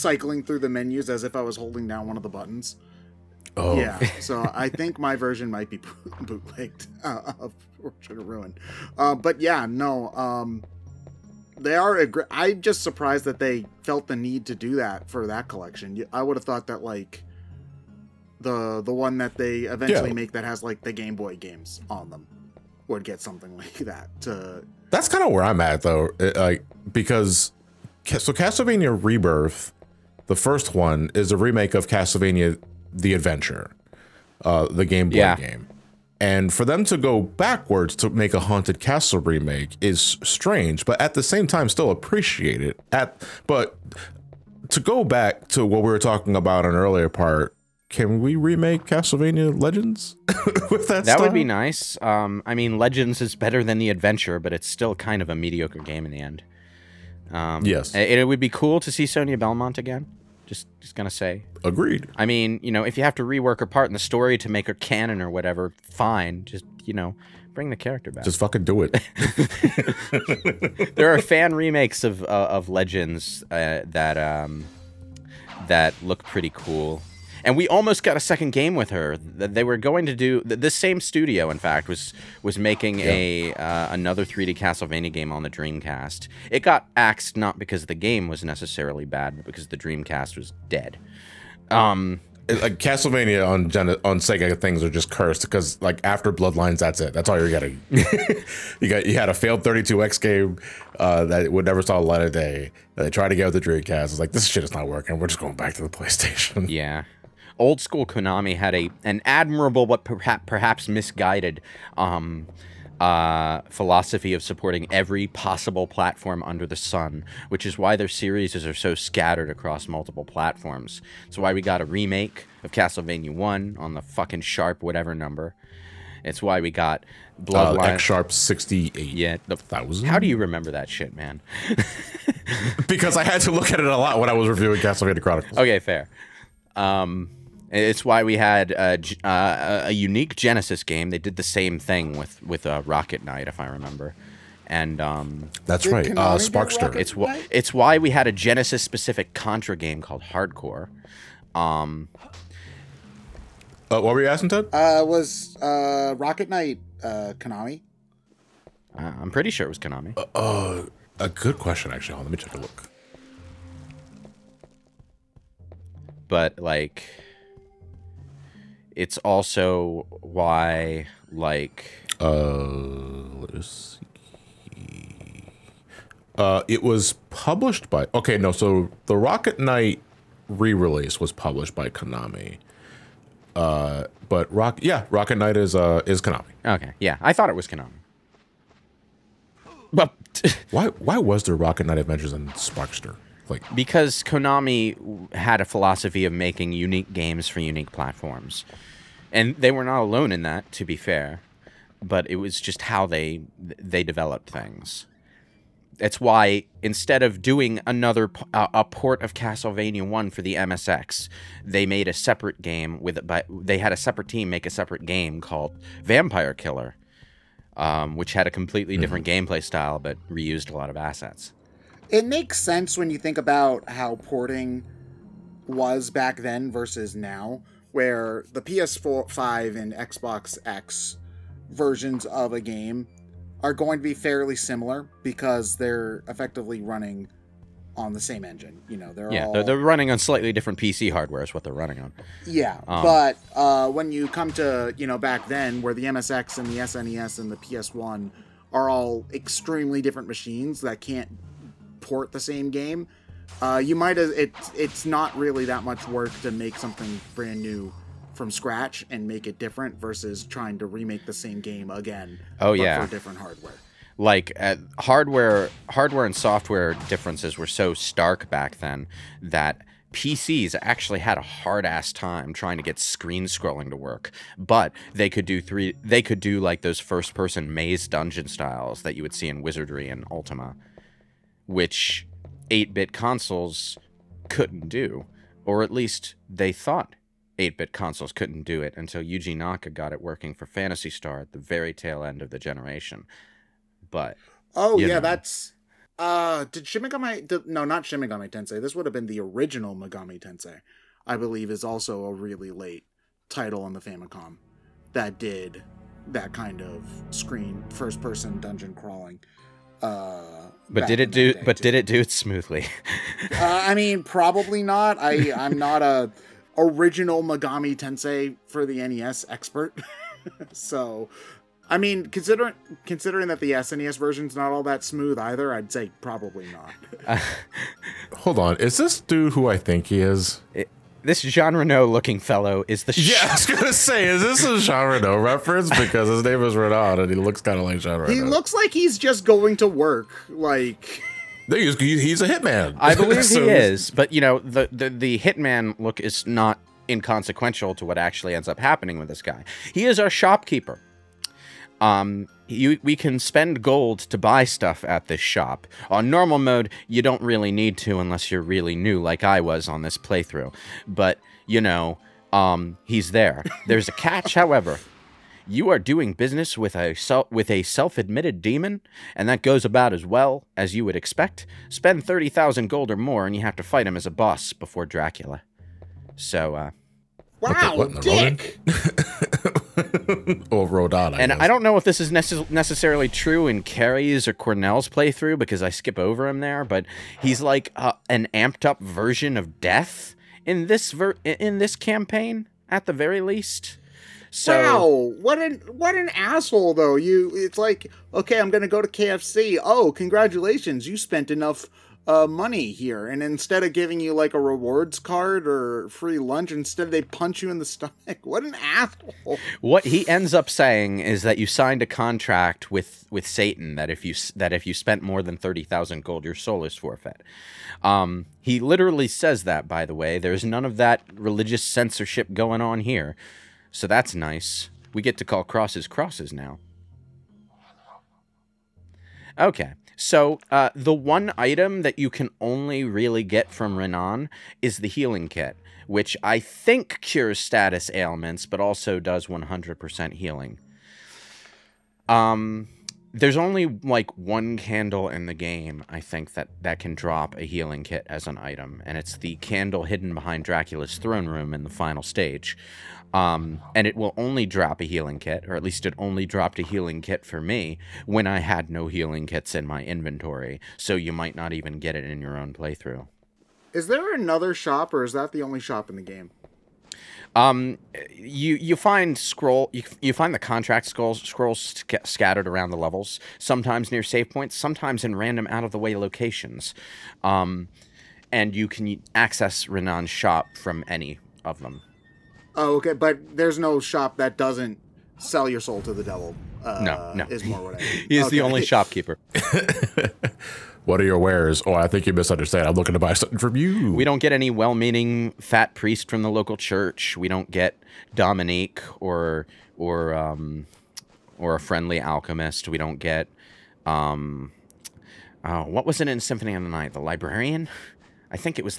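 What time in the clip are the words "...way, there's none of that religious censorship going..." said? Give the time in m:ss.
7:00.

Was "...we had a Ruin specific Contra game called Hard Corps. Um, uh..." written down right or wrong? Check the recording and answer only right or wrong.
wrong.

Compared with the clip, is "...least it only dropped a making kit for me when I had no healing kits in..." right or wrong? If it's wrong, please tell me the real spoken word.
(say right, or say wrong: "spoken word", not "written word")
wrong: "healing", not "making".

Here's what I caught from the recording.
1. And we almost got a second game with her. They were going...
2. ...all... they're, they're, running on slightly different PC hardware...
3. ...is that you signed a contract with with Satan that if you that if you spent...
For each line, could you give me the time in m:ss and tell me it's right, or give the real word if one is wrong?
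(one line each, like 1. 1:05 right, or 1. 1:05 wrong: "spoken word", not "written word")
1. 1:17 right
2. 3:59 right
3. 6:51 right.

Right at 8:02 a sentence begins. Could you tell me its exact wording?
Oh, okay, but there's no shop that doesn't sell your soul to the devil.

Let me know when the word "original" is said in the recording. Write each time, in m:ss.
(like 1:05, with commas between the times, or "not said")
4:59, 5:16.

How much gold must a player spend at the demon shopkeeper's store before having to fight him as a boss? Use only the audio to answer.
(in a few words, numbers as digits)
30,000 gold.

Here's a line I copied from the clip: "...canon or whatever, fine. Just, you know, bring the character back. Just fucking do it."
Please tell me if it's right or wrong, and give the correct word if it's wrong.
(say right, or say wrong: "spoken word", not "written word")
right.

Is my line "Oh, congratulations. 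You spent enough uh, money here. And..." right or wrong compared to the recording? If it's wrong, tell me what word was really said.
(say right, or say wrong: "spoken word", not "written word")
right.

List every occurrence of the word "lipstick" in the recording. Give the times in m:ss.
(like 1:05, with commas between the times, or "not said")
not said.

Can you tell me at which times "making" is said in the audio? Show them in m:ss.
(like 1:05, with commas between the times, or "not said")
1:22, 3:16.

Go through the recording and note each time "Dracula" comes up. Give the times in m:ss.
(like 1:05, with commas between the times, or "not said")
6:15, 7:30.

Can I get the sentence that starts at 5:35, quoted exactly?
Because his name is Renault, and he looks kind of like Jean Renault.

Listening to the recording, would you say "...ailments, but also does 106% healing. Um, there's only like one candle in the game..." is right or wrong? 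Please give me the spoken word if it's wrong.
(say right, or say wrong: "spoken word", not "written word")
wrong: "100", not "106".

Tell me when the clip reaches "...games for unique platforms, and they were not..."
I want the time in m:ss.
3:17.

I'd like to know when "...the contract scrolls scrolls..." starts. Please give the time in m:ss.
7:50.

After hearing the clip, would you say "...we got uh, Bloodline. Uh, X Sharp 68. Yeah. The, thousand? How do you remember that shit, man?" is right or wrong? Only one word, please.
right.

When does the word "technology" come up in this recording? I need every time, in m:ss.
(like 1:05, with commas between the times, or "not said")
not said.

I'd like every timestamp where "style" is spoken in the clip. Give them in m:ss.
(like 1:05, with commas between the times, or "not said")
0:51, 3:39, 4:38.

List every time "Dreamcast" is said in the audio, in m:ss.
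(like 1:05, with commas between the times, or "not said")
1:25, 1:29, 1:43.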